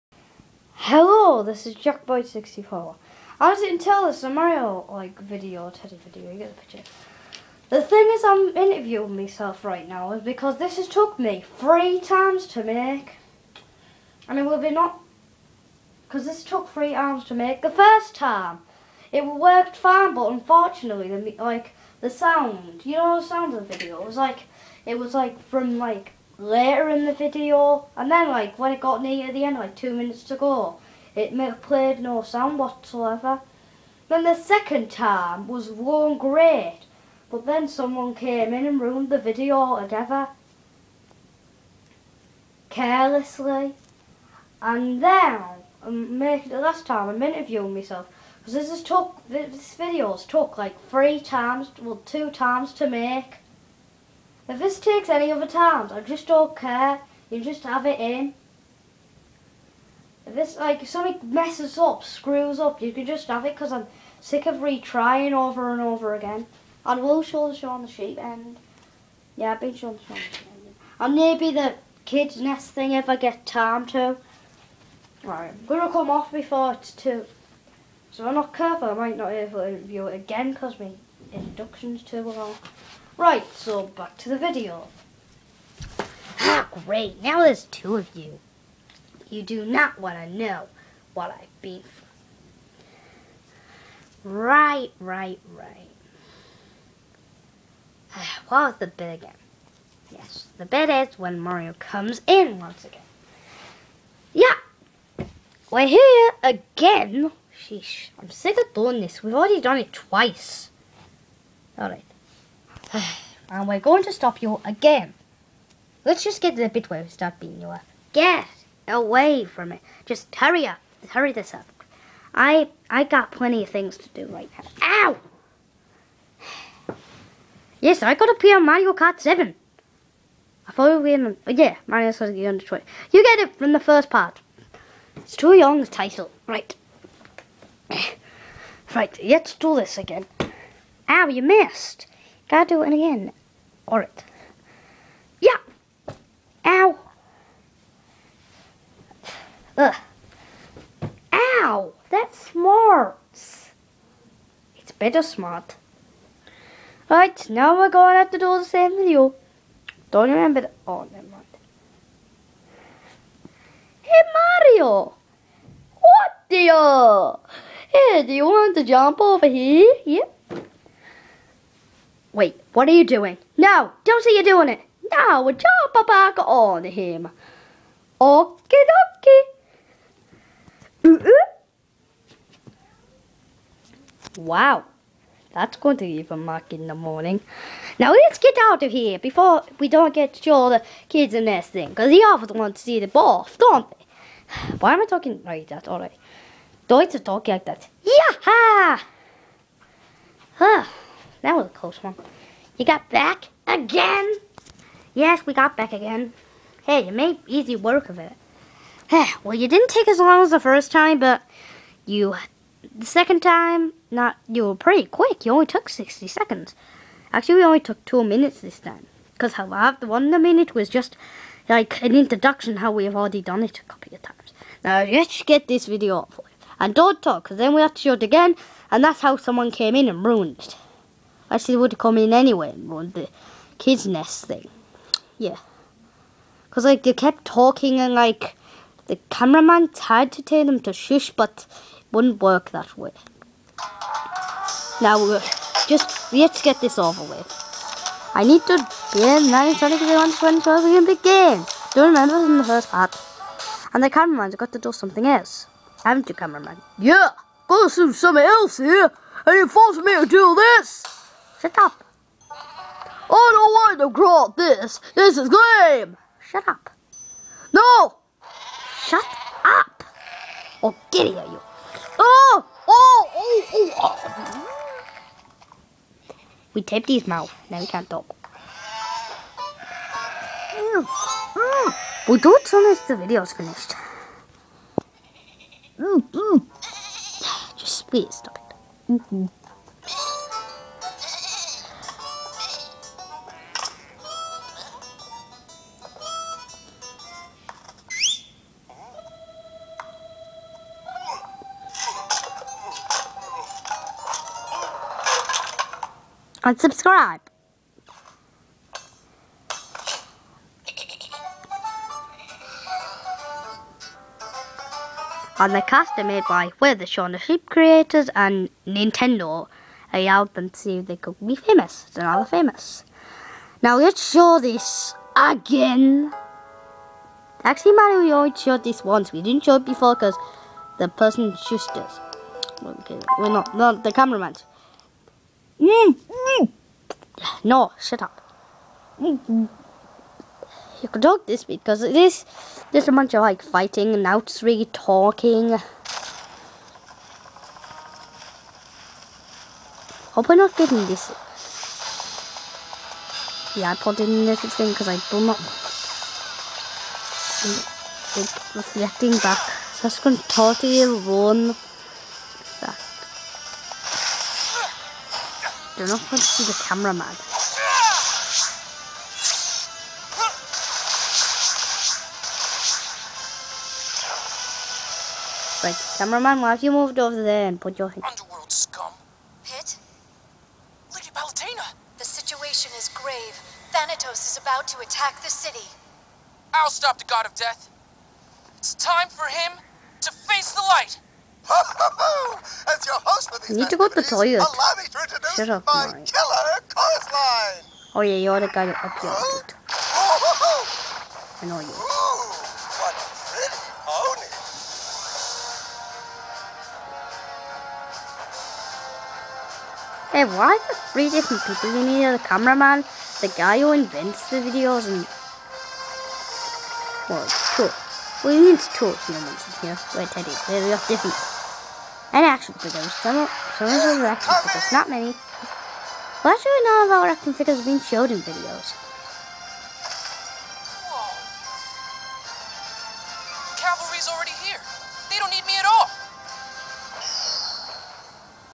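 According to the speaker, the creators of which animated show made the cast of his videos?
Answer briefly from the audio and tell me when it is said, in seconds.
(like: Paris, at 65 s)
Shaun the Sheep, at 317 s.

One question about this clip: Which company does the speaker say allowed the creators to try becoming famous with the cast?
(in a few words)
Nintendo.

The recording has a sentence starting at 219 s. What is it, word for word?
Because how I've the one the minute was just like an introduction how we have already done it a couple of times.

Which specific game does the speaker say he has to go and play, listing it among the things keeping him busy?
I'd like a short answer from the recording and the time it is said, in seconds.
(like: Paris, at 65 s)
Mario Kart 7, at 128 s.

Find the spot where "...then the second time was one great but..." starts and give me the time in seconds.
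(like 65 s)
34 s.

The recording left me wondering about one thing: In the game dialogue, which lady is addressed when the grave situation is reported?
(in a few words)
Lady Palutena.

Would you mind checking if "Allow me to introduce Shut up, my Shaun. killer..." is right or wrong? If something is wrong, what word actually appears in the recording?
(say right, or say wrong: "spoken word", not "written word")
wrong: "Mario", not "Shaun".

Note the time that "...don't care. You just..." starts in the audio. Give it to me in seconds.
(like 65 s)
56 s.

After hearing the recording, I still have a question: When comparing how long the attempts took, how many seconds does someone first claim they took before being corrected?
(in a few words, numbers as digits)
60.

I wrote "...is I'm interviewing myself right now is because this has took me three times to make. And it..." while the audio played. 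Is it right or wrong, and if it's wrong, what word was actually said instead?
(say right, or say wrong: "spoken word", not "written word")
right.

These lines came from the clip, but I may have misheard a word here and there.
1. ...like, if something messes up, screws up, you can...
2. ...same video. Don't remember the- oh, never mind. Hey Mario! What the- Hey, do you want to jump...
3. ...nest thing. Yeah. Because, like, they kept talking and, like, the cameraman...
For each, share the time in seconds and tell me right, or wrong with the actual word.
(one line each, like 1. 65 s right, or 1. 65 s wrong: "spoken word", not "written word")
1. 60 s right
2. 158 s right
3. 234 s right.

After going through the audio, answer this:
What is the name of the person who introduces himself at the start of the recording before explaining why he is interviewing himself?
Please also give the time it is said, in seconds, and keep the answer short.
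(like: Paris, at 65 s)
Jackboyd64, at 1 s.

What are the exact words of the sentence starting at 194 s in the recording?
Why am I talking like that All Don't talk like that.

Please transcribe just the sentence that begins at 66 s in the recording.
And we'll show the show on the sheep end.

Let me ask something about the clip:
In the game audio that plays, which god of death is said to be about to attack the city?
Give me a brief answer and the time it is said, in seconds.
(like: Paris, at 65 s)
Thanatos, at 383 s.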